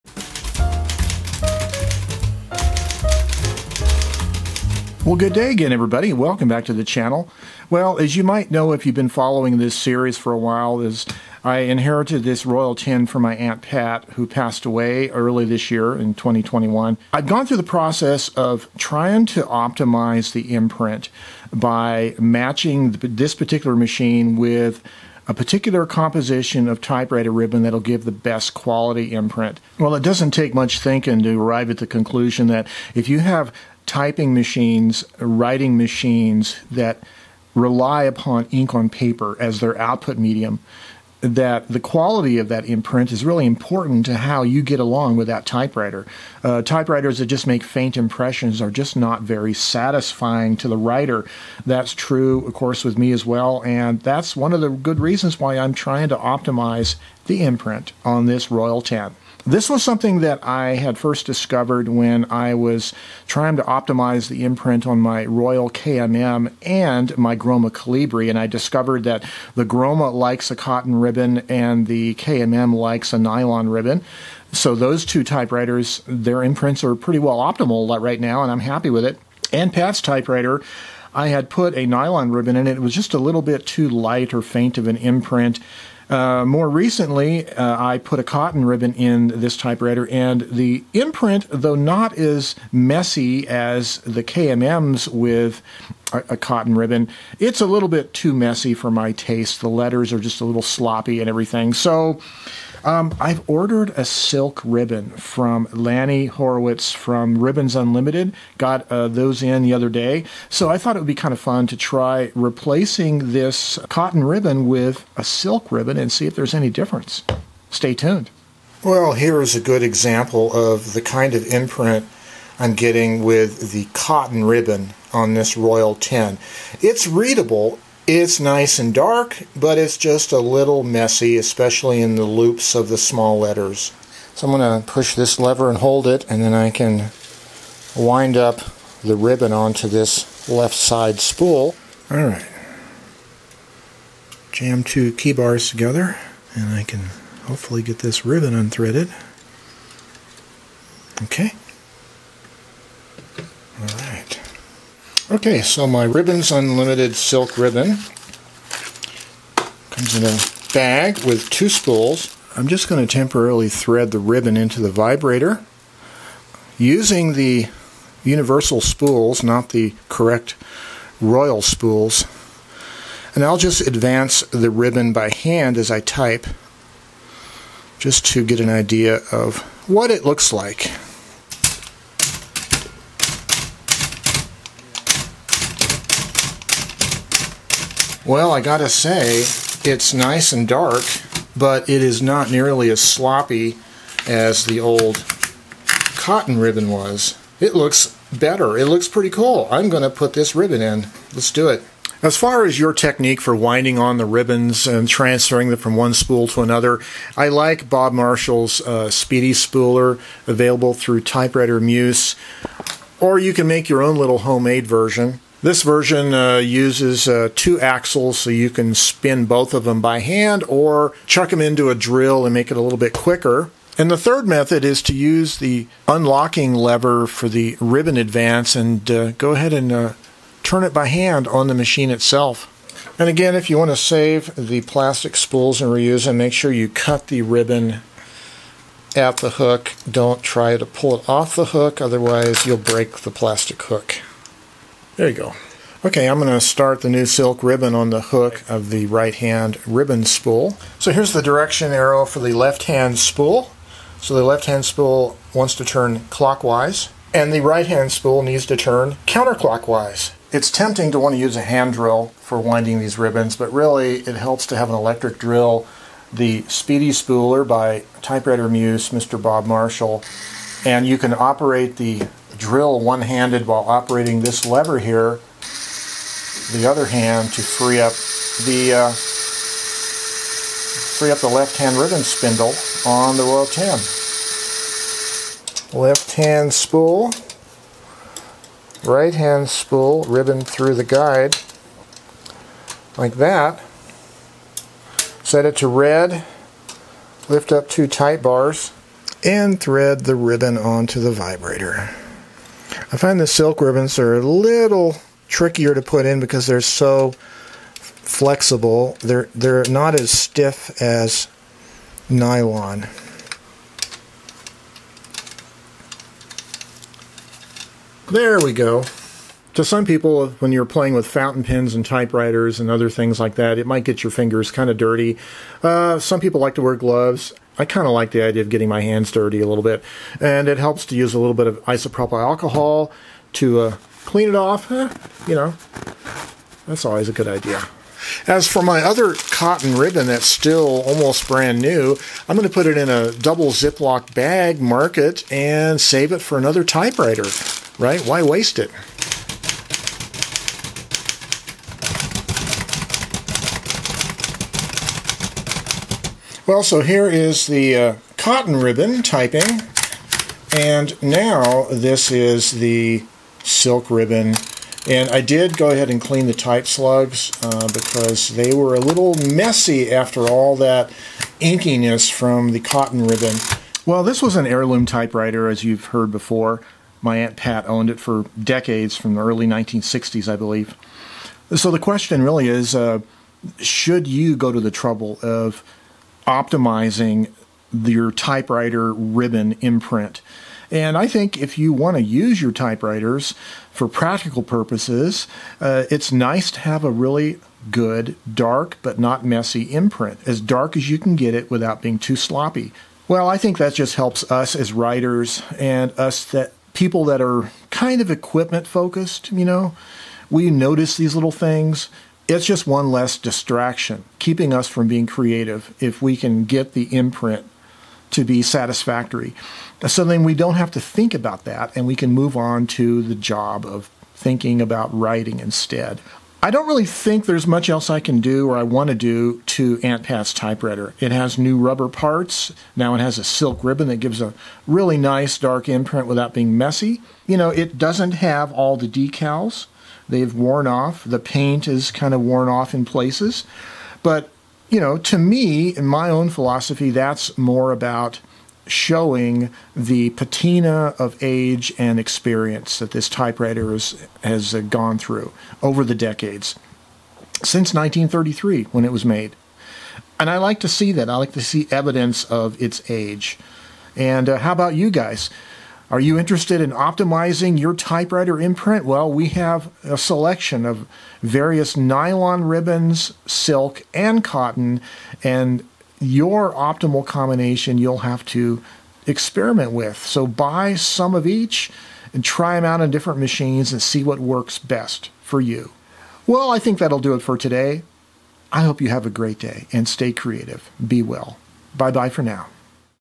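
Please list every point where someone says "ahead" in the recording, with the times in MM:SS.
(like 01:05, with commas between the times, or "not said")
03:49, 06:05.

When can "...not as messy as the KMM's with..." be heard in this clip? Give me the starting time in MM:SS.
01:31.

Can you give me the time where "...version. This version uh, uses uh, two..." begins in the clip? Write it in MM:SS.
03:34.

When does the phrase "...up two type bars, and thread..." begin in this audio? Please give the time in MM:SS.
04:57.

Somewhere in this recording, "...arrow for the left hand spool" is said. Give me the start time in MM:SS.
04:11.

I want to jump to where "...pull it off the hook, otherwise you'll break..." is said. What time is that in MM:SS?
04:00.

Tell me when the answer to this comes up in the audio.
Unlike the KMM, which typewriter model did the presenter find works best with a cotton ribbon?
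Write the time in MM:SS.
01:07.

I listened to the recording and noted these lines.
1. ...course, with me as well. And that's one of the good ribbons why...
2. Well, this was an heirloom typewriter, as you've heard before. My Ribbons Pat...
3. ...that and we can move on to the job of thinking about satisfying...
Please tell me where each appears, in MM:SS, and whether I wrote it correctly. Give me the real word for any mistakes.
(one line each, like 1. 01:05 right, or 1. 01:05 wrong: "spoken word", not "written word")
1. 00:52 wrong: "reasons", not "ribbons"
2. 06:14 wrong: "Aunt", not "Ribbons"
3. 07:01 wrong: "writing", not "satisfying".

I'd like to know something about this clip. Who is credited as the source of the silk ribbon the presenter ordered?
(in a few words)
Lanny Horowitz.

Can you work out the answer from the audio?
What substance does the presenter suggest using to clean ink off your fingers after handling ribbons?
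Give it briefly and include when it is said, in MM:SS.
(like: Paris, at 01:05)
isopropyl alcohol, at 05:31.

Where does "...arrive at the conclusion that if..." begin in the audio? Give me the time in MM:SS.
00:31.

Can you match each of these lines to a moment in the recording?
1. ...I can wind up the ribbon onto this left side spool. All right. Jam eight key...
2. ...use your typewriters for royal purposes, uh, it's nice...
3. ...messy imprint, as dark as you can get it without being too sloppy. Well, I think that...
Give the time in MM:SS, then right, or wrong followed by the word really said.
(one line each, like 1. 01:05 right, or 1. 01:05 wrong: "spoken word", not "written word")
1. 02:16 wrong: "two", not "eight"
2. 06:32 wrong: "practical", not "royal"
3. 06:39 right.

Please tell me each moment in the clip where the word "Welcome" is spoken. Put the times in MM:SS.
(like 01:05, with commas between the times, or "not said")
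00:06.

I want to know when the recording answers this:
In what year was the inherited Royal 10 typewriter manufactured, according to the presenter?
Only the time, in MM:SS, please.
07:37.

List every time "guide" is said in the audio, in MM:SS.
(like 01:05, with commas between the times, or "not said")
04:51.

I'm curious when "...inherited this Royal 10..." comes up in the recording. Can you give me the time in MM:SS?
00:11.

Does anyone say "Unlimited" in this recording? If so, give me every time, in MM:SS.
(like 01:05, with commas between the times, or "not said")
01:47, 02:36.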